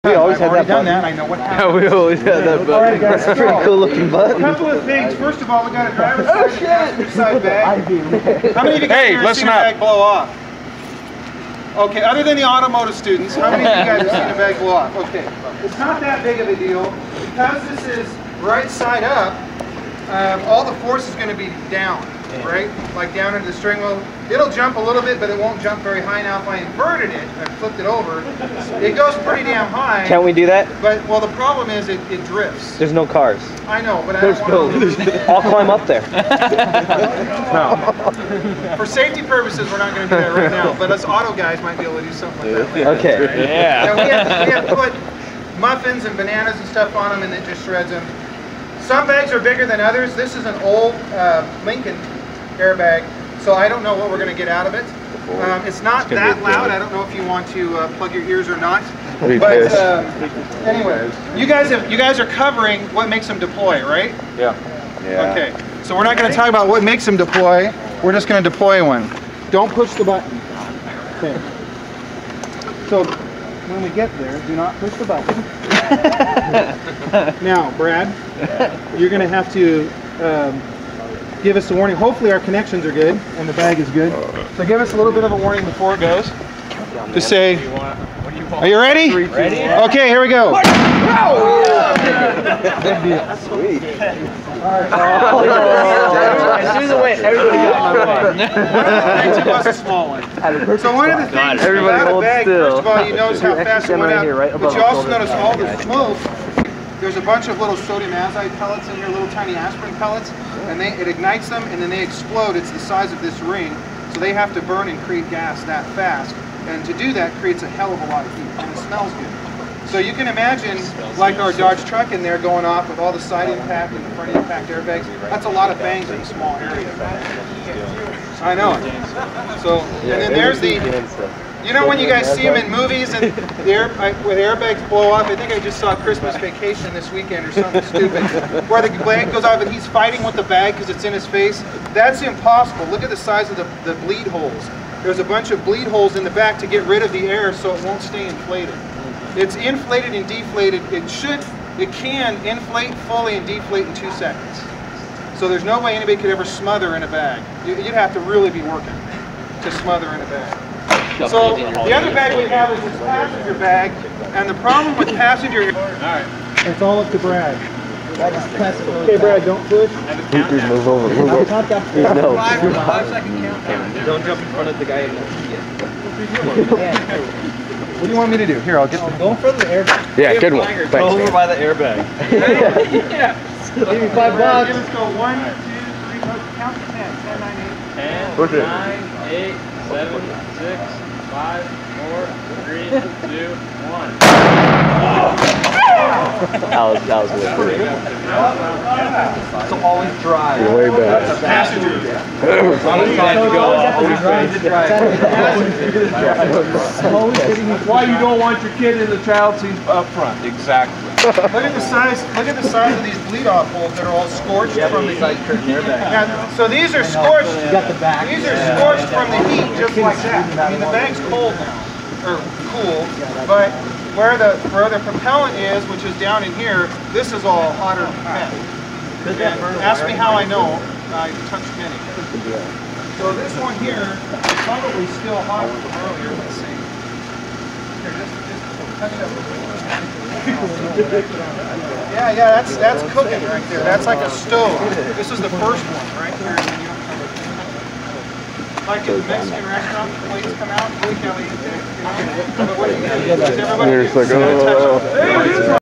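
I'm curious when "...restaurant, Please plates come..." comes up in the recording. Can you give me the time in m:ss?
4:09.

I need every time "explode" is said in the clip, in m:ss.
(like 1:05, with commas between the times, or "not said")
1:52.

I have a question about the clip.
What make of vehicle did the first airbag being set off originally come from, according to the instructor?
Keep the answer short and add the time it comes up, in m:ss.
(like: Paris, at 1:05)
Lincoln, at 0:51.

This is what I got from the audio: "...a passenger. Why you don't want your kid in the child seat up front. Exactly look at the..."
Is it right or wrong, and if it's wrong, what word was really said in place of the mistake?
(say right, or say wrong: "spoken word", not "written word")
right.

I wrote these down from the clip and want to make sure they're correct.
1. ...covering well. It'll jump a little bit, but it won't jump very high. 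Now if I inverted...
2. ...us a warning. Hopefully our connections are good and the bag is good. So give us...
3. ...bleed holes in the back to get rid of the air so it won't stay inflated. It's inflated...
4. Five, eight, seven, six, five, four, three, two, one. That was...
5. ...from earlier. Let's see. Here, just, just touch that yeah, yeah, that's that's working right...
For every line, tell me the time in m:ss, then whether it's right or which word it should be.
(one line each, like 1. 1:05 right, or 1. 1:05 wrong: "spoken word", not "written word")
1. 0:23 wrong: "string", not "covering"
2. 1:21 right
3. 2:25 right
4. 3:08 wrong: "Nine", not "Five"
5. 3:55 wrong: "cooking", not "working".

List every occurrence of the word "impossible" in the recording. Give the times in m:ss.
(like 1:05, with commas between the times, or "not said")
2:22.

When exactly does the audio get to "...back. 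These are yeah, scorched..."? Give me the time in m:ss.
3:38.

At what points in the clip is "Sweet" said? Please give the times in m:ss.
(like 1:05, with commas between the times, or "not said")
1:33.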